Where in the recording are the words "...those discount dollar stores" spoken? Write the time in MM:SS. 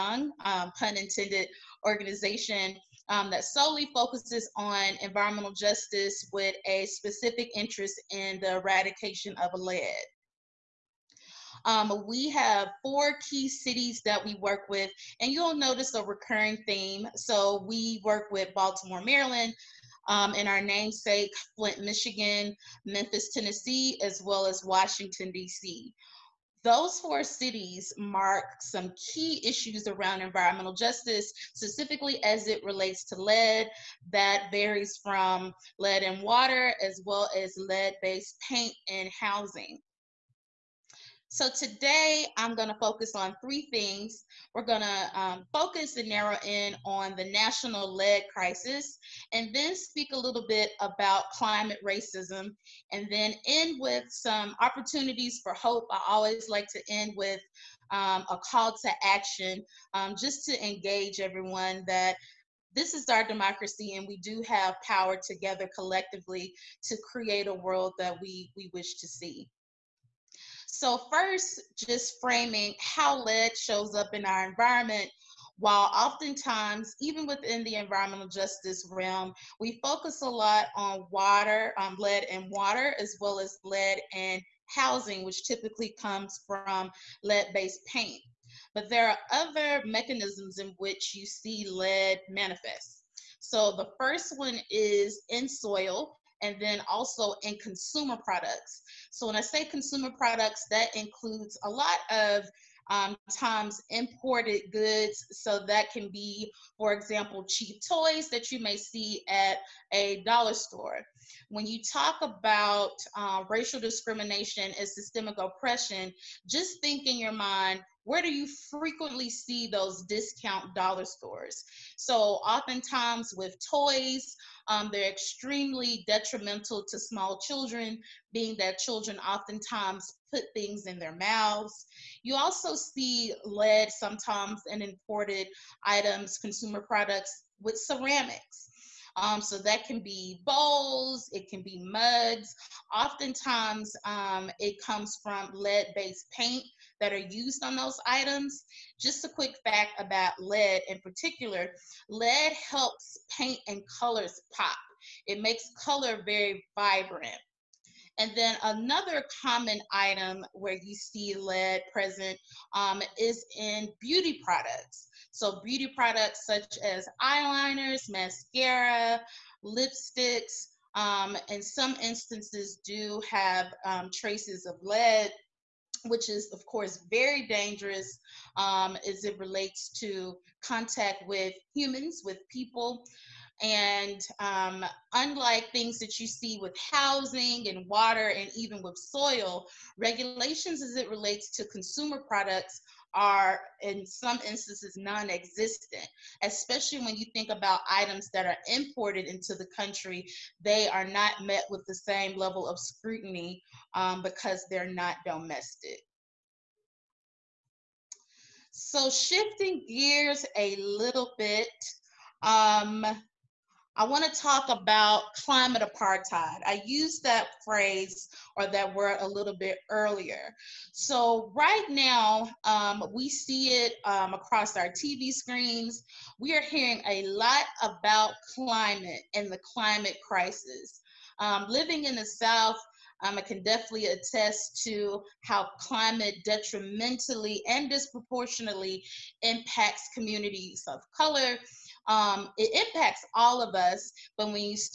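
01:59.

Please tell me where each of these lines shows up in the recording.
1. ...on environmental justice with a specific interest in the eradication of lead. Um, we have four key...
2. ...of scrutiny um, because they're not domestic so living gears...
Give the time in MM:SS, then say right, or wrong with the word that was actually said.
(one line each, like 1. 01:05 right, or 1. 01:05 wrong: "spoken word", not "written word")
1. 00:04 right
2. 03:22 wrong: "shifting", not "living".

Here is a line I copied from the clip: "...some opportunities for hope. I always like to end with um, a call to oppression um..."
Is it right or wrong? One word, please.
wrong.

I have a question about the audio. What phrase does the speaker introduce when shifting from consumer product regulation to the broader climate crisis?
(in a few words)
Climate apartheid.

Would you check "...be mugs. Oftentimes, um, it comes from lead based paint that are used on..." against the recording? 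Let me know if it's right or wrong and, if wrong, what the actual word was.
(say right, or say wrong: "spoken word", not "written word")
right.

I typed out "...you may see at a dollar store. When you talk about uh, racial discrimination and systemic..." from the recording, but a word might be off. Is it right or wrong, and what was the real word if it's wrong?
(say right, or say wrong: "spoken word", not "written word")
right.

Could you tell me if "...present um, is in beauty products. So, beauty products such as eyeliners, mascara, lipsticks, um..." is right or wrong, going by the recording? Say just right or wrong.
right.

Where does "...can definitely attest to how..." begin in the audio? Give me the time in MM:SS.
03:53.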